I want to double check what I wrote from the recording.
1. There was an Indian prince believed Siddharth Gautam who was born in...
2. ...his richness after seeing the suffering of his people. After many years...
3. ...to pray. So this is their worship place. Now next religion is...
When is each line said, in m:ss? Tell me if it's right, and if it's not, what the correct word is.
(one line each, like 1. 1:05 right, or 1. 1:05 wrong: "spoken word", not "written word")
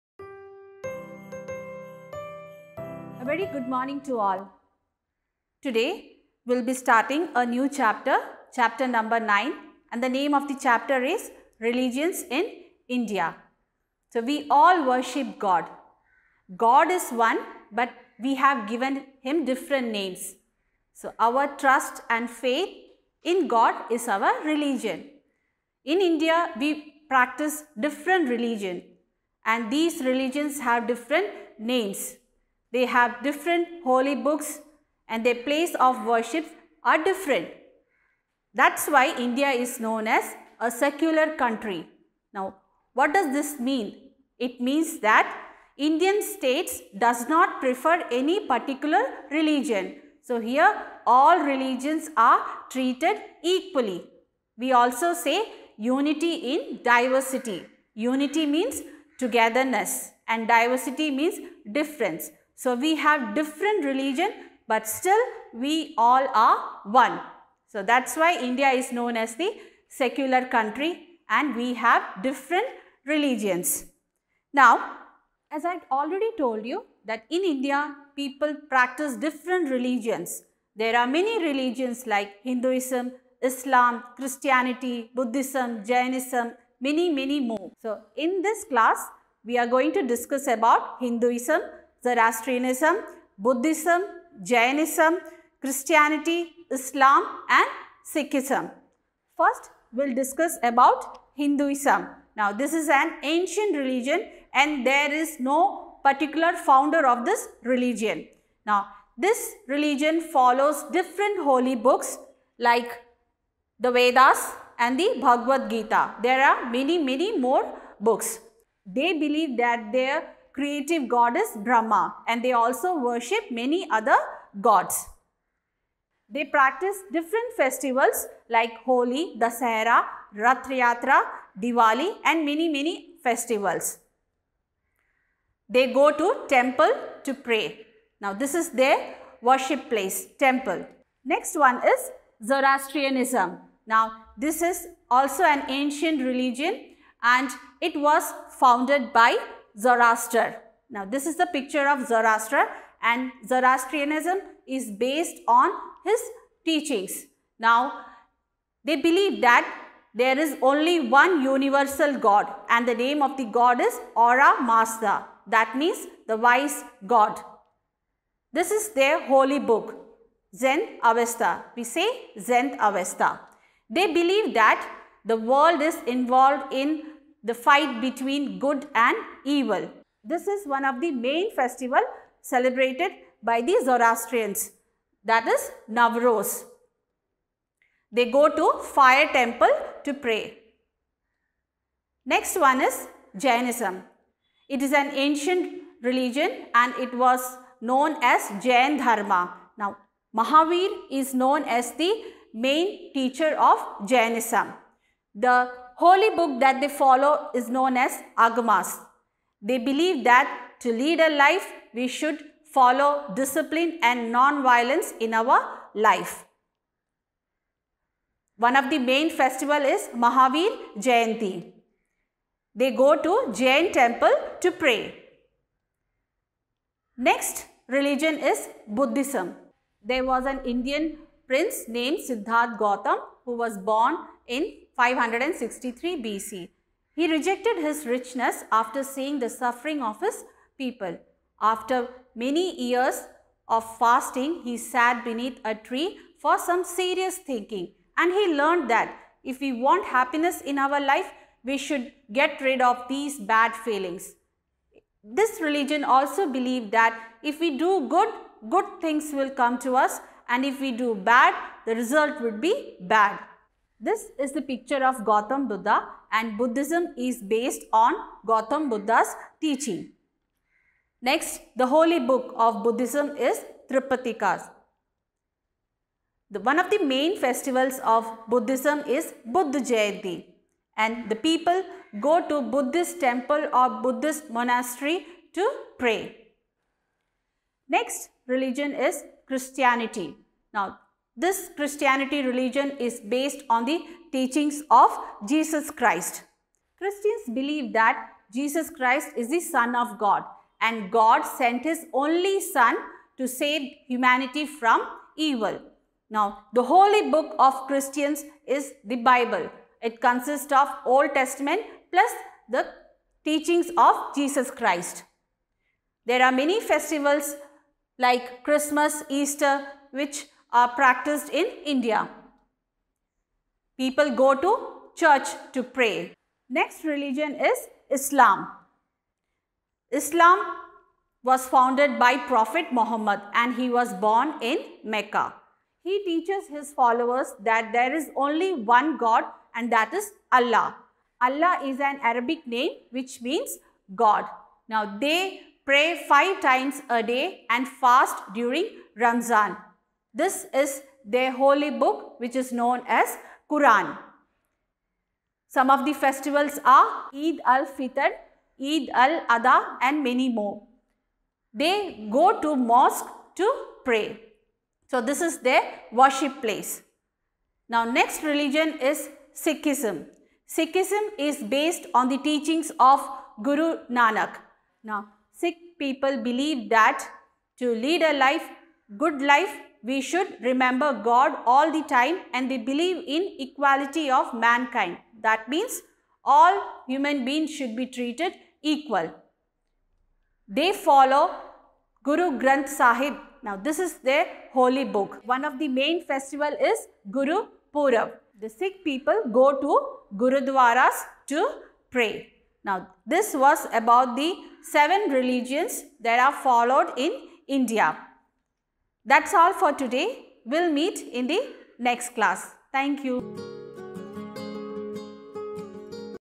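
1. 3:50 wrong: "named", not "believed"
2. 3:57 right
3. 6:03 right.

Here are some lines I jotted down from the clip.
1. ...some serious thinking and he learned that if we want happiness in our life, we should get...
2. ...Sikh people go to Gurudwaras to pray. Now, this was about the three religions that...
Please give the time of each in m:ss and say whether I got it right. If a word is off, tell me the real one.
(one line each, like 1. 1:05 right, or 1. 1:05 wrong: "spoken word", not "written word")
1. 4:06 right
2. 6:38 wrong: "seven", not "three".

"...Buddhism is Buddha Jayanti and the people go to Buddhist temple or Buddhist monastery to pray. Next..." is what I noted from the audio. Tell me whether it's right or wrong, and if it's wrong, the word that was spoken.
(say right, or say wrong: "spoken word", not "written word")
right.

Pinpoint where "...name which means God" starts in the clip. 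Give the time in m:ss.
5:42.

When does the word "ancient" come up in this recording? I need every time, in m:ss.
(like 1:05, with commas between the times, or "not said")
1:43, 2:25, 3:15.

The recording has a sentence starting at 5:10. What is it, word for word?
It consists of Old Testament plus the teachings of Jesus Christ.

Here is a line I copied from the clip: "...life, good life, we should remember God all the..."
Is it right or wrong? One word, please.
right.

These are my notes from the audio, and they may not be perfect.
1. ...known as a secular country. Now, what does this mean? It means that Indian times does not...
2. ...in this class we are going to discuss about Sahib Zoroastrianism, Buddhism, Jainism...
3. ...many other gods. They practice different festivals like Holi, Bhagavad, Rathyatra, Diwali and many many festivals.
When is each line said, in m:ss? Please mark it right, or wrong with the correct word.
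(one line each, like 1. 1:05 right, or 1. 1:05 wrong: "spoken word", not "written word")
1. 0:39 wrong: "states", not "times"
2. 1:28 wrong: "Hinduism", not "Sahib"
3. 2:03 wrong: "Dasahara", not "Bhagavad".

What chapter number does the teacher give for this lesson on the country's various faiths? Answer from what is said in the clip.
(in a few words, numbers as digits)
9.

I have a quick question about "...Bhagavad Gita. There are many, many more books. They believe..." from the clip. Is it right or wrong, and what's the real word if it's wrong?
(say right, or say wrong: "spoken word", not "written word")
right.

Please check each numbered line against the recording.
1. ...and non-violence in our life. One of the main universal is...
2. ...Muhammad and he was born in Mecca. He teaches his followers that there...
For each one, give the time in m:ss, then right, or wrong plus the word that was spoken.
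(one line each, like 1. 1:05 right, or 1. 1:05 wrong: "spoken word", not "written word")
1. 3:34 wrong: "festival", not "universal"
2. 5:32 right.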